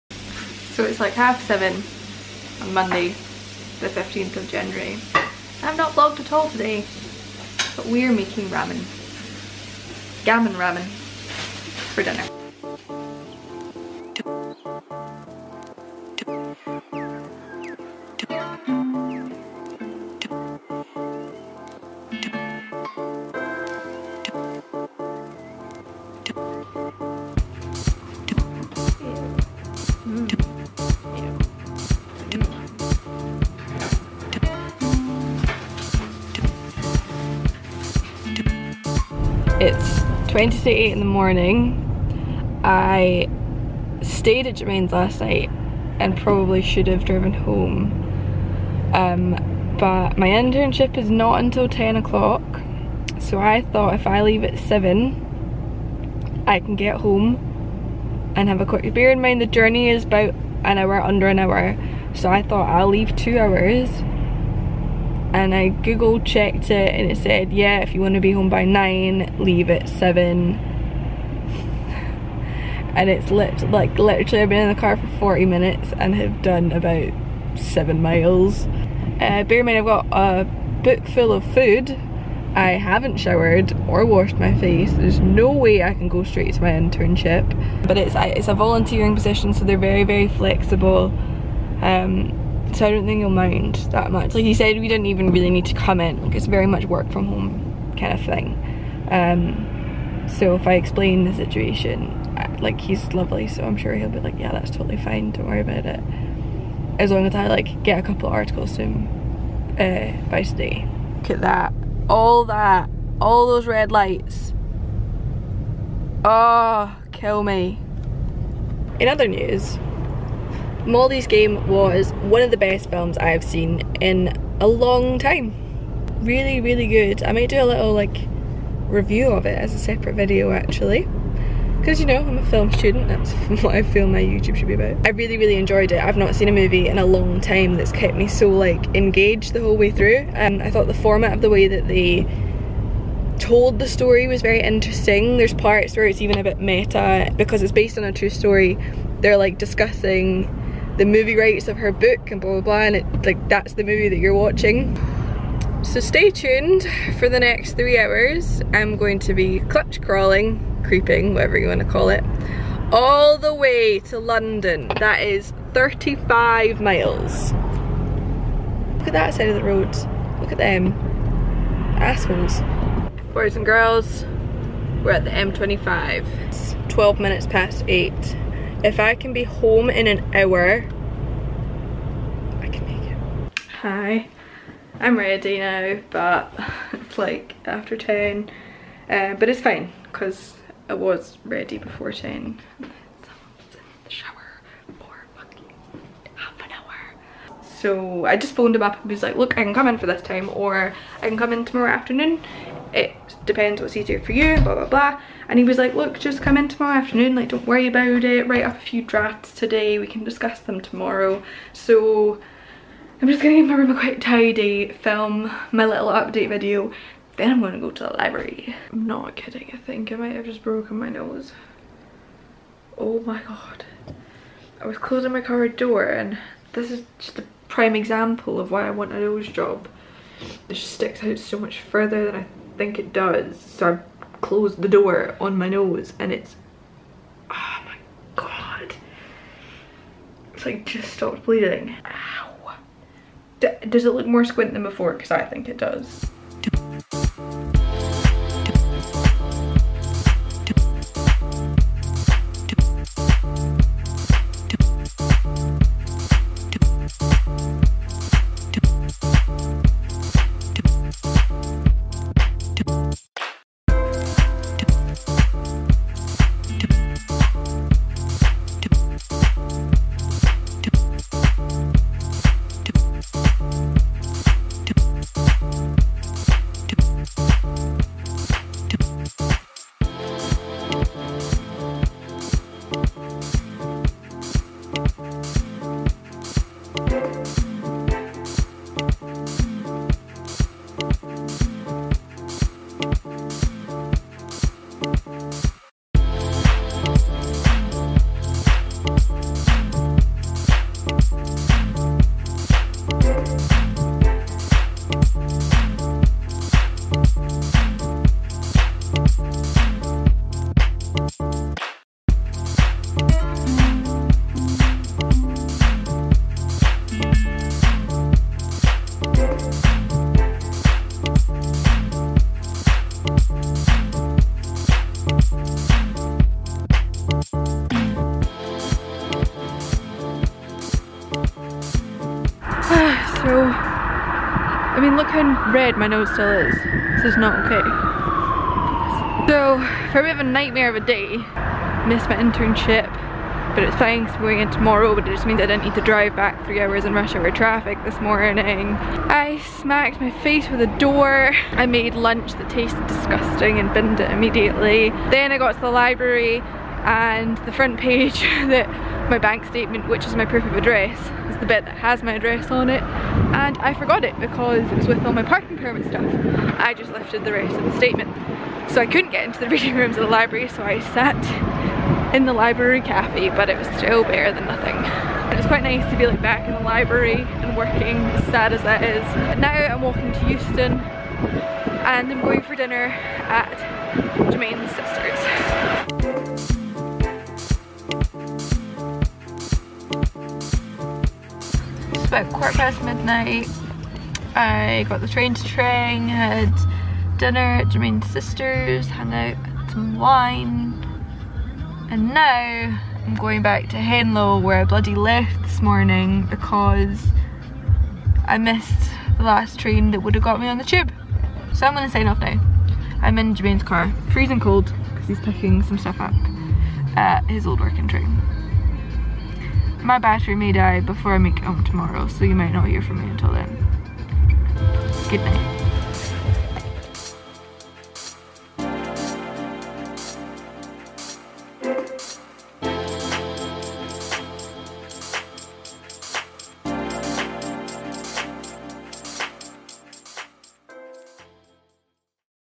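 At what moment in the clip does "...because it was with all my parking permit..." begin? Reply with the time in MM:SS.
06:04.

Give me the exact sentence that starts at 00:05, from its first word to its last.
I've not vlogged at all today, but we're making ramen.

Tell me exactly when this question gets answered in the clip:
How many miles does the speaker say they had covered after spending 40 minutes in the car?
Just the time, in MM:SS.
01:16.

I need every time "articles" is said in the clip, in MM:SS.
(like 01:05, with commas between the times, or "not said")
01:48.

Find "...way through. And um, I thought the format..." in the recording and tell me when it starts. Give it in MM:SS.
02:19.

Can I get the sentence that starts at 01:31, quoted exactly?
Um, so I don't think you'll mind that much.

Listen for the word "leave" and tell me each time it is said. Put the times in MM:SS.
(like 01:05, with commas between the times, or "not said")
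00:54, 01:02, 01:09.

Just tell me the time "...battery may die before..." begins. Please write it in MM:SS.
07:00.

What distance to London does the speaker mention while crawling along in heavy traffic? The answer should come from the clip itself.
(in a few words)
35 miles.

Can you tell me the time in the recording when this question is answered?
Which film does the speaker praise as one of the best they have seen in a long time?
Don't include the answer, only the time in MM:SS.
02:00.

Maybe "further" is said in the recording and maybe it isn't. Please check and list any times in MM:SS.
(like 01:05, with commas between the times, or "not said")
03:51.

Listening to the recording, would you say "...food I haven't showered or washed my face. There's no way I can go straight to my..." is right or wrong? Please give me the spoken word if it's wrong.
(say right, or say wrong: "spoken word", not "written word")
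right.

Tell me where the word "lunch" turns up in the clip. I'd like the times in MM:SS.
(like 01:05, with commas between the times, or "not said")
05:52.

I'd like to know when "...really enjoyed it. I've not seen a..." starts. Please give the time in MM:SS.
02:15.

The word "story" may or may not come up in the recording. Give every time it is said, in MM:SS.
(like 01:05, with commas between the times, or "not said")
02:23, 02:28.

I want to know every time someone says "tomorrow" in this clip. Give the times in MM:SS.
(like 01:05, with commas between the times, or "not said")
03:21, 03:26, 03:30, 05:44, 07:01.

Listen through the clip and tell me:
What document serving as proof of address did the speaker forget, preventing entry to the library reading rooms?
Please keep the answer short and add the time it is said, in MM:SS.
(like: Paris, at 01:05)
Bank statement, at 05:59.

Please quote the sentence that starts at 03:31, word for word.
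So I'm just gonna give my room a quick tidy, film my little update video, then I'm gonna go to the library.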